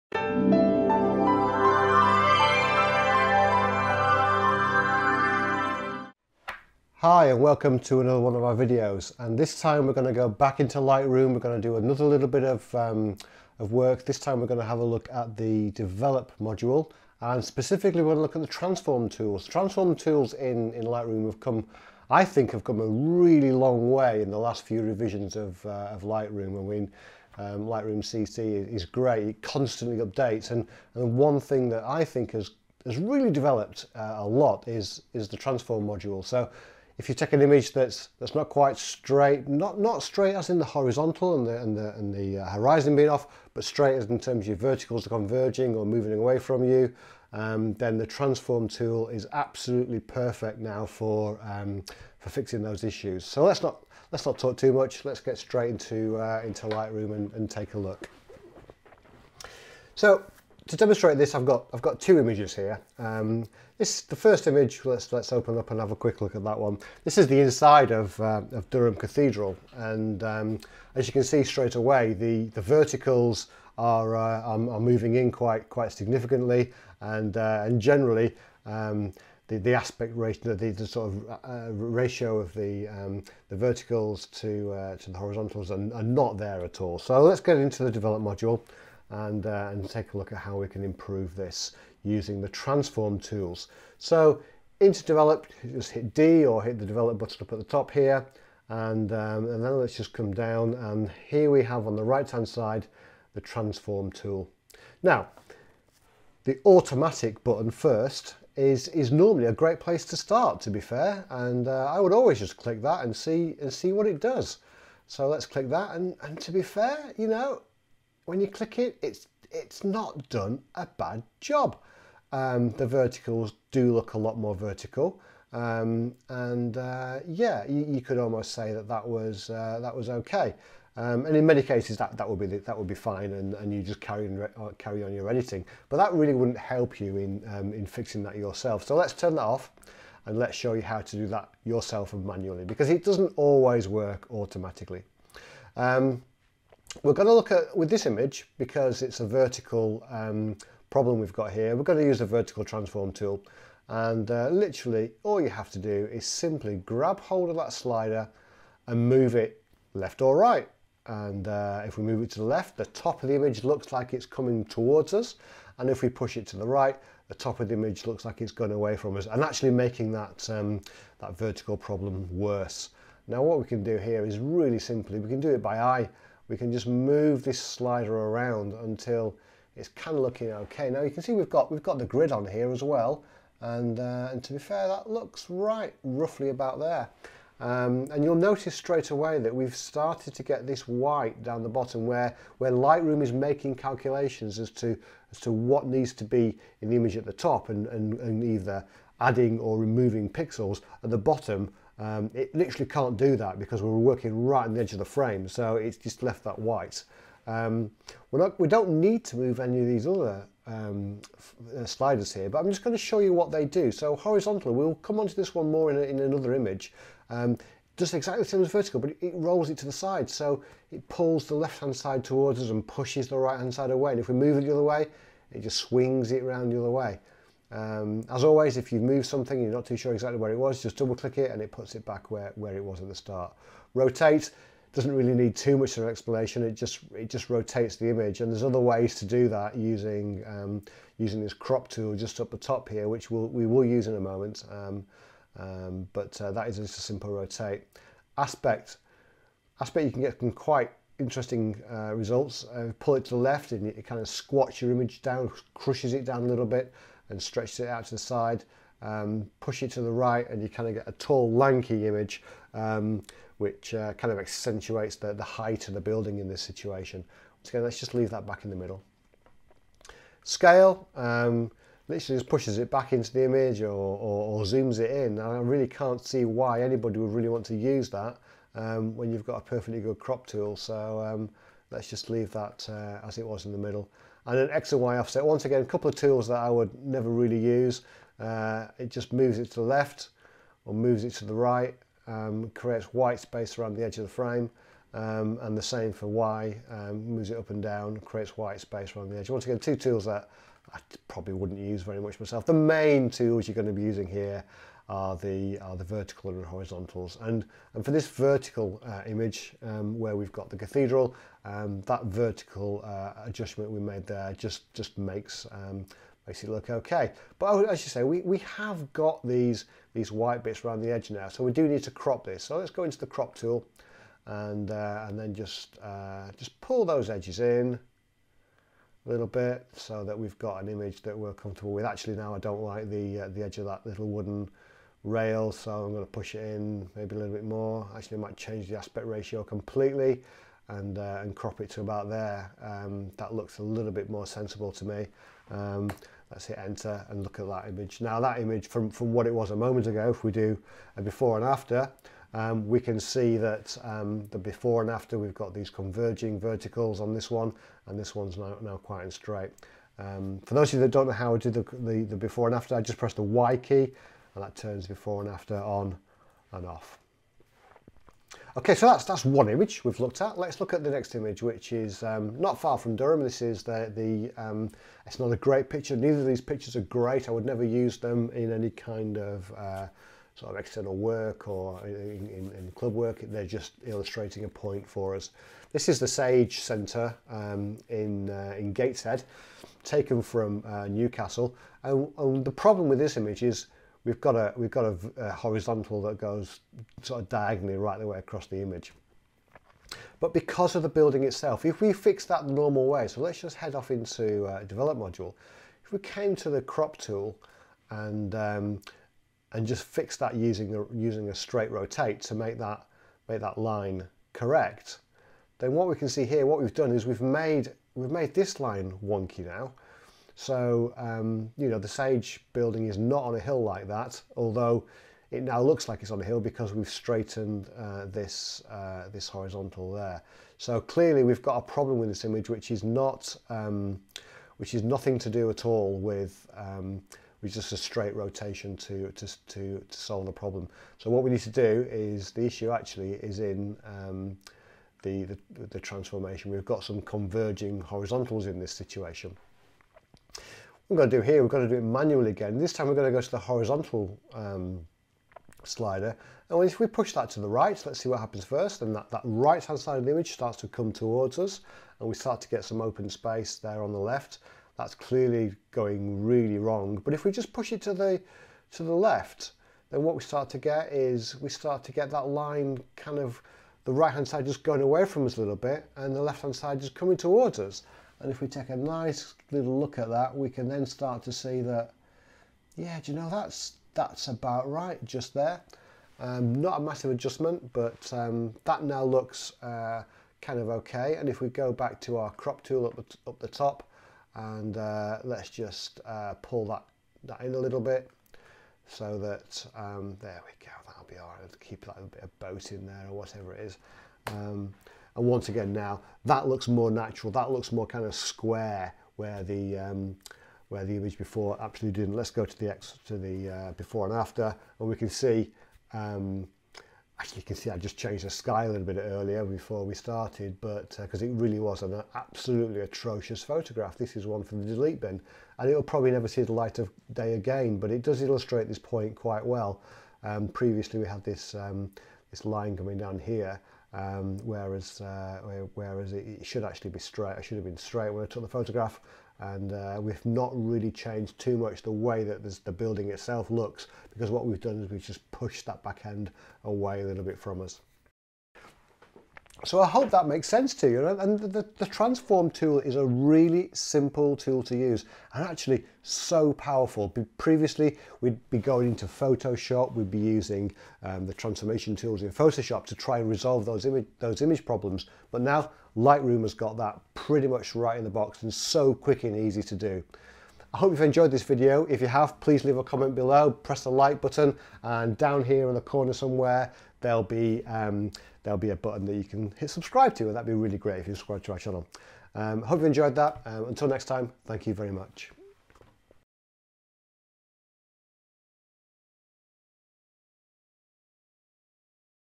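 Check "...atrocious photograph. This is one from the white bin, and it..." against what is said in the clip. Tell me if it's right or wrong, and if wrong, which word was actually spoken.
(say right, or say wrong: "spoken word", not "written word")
wrong: "delete", not "white".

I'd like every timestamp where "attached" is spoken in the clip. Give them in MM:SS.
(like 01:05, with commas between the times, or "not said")
not said.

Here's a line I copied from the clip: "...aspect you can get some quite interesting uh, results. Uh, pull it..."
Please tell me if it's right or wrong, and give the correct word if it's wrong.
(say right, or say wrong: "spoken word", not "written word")
right.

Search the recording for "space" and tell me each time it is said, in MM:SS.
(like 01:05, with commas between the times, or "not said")
04:53, 04:58, 07:43.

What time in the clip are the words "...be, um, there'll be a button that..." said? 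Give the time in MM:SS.
09:37.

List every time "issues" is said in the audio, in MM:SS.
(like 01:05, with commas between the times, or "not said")
00:52, 07:22.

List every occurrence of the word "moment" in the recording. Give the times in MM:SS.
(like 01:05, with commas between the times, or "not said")
04:04, 05:49.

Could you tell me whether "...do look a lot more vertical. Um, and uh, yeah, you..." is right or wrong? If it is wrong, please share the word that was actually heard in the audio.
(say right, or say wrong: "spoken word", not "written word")
right.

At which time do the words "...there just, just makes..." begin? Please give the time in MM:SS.
05:14.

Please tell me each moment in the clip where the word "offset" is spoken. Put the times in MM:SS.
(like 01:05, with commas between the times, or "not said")
04:45.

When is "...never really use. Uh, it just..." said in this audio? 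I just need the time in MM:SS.
04:47.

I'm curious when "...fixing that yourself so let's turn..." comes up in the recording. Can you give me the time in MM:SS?
02:17.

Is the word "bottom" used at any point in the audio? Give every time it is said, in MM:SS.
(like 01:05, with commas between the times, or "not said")
03:11, 03:21.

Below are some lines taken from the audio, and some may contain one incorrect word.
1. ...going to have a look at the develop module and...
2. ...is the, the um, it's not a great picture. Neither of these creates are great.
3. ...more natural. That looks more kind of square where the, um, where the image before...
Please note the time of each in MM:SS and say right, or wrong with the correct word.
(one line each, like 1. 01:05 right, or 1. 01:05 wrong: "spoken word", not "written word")
1. 00:14 right
2. 06:13 wrong: "pictures", not "creates"
3. 08:26 right.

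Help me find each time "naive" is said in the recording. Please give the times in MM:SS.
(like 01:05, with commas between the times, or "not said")
not said.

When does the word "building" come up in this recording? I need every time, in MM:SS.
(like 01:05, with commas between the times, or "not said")
04:26, 06:41, 07:02, 09:02.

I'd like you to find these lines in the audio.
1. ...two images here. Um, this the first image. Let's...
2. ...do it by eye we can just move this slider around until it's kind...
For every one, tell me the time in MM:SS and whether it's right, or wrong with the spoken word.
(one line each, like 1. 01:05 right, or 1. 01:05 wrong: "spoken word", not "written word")
1. 01:01 right
2. 02:55 right.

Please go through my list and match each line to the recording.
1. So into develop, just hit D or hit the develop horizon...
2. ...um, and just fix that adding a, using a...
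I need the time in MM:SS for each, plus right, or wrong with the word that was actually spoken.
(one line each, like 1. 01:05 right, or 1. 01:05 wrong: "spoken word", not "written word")
1. 01:33 wrong: "button", not "horizon"
2. 06:48 wrong: "using", not "adding".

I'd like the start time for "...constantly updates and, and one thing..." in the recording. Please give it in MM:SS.
00:29.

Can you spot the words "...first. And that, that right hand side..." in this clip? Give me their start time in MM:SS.
07:38.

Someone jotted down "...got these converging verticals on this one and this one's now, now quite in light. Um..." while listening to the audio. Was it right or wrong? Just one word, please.
wrong.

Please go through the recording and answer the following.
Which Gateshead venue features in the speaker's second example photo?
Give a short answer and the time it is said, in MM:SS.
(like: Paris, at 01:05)
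Sage Centre, at 06:26.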